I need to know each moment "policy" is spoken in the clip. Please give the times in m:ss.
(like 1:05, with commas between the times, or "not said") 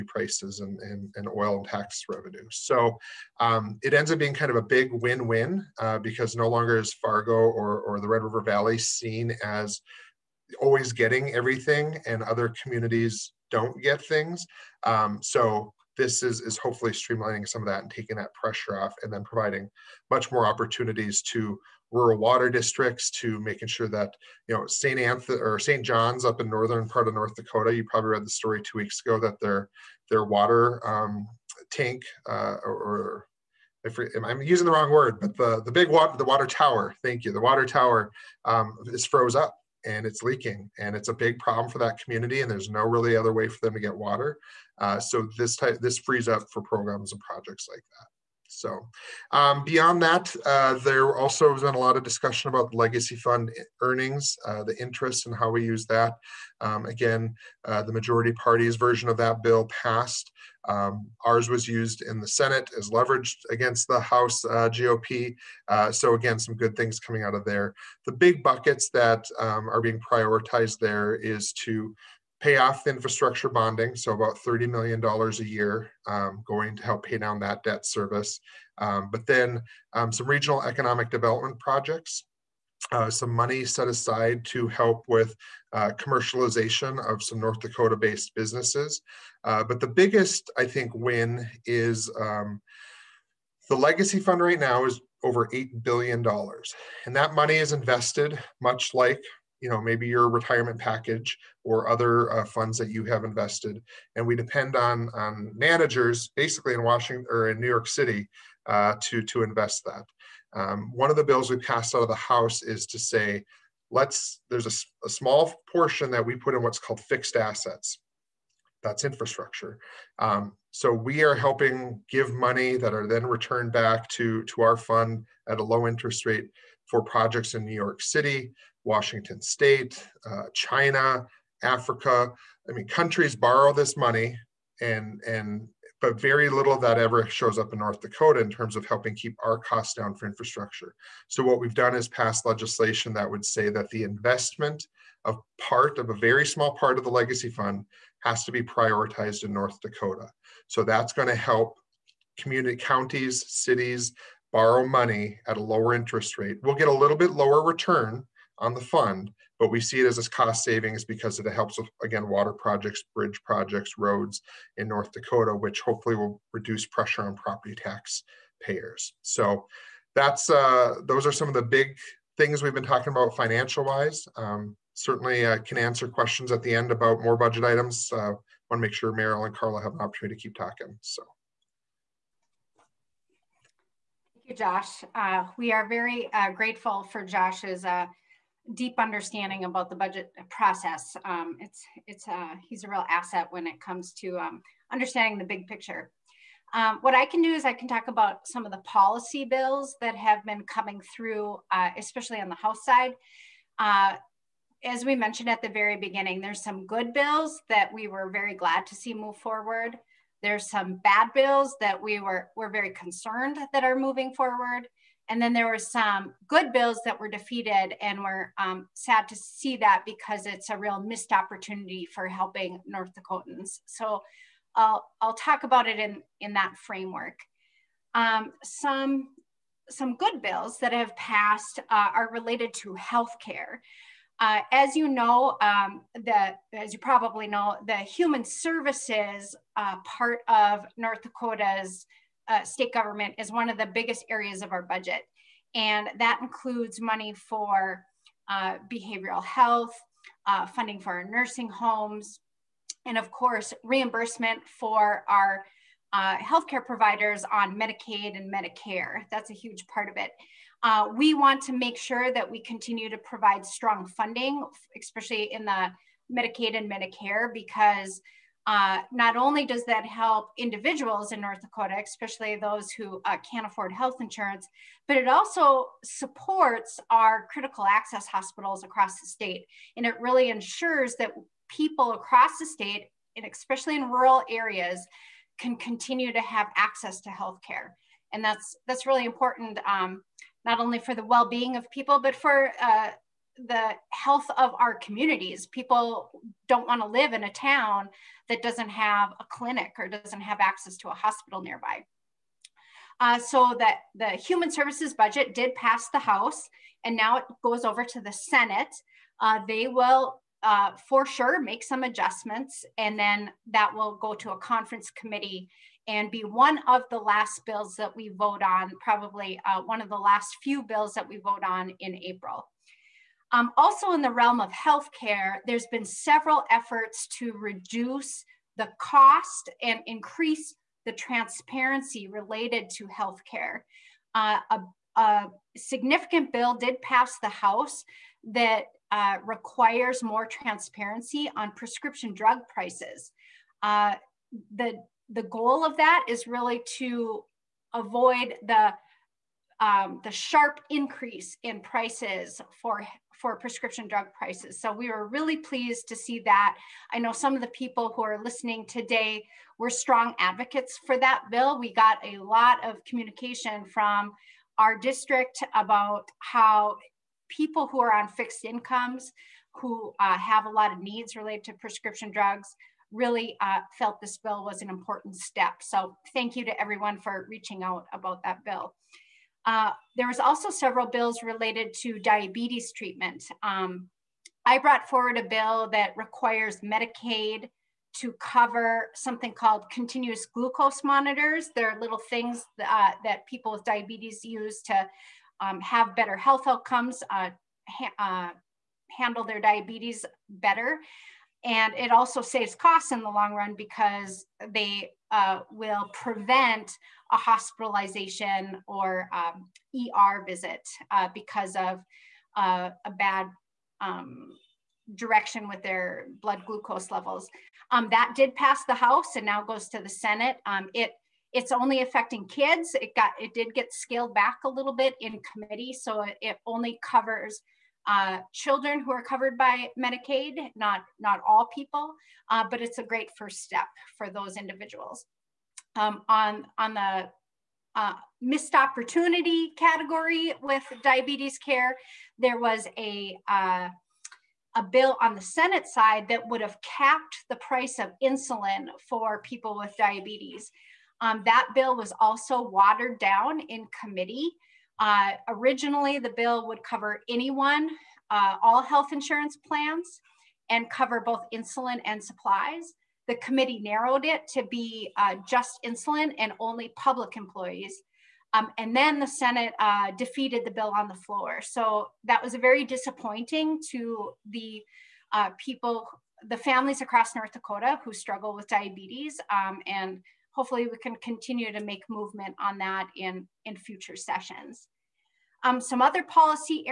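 3:18, 8:06.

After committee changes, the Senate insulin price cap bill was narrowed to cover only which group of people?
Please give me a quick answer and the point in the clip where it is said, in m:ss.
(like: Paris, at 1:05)
public employees, at 7:46.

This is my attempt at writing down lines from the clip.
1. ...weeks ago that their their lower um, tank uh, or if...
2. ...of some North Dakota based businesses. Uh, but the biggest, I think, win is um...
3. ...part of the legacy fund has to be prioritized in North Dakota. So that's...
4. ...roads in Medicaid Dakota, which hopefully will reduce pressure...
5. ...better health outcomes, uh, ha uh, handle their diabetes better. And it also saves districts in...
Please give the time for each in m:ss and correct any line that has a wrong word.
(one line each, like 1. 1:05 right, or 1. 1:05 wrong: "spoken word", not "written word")
1. 0:28 wrong: "water", not "lower"
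2. 1:27 right
3. 2:26 right
4. 2:43 wrong: "North", not "Medicaid"
5. 6:36 wrong: "costs", not "districts".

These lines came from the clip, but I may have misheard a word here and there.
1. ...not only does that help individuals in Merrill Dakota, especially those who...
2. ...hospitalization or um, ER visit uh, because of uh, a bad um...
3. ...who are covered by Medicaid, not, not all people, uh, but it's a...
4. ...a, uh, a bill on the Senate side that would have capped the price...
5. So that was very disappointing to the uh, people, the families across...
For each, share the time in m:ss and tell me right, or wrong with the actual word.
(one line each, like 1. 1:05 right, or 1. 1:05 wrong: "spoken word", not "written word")
1. 4:29 wrong: "North", not "Merrill"
2. 6:47 right
3. 7:09 right
4. 7:22 right
5. 7:51 right.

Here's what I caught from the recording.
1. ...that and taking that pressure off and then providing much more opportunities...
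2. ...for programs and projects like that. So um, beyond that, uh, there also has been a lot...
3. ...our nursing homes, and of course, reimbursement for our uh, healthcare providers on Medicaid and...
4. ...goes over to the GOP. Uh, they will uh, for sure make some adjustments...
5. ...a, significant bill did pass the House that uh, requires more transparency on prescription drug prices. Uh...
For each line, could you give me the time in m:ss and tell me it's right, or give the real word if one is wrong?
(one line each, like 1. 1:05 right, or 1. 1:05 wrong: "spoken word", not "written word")
1. 0:17 right
2. 0:46 right
3. 4:11 right
4. 5:07 wrong: "Senate", not "GOP"
5. 5:35 right.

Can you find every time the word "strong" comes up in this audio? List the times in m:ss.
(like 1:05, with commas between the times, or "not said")
4:23, 5:59.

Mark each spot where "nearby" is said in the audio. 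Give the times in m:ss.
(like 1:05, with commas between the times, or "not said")
5:01.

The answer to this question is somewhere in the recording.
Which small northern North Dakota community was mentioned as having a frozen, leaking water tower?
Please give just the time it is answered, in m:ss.
0:25.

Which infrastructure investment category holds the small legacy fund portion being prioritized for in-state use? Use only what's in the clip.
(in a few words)
fixed assets.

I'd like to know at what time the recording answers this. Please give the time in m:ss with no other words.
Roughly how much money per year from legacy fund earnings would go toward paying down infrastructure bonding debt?
1:14.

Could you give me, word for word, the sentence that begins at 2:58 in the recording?
Uh, want to make sure Merrill and Karla have an opportunity to keep talking.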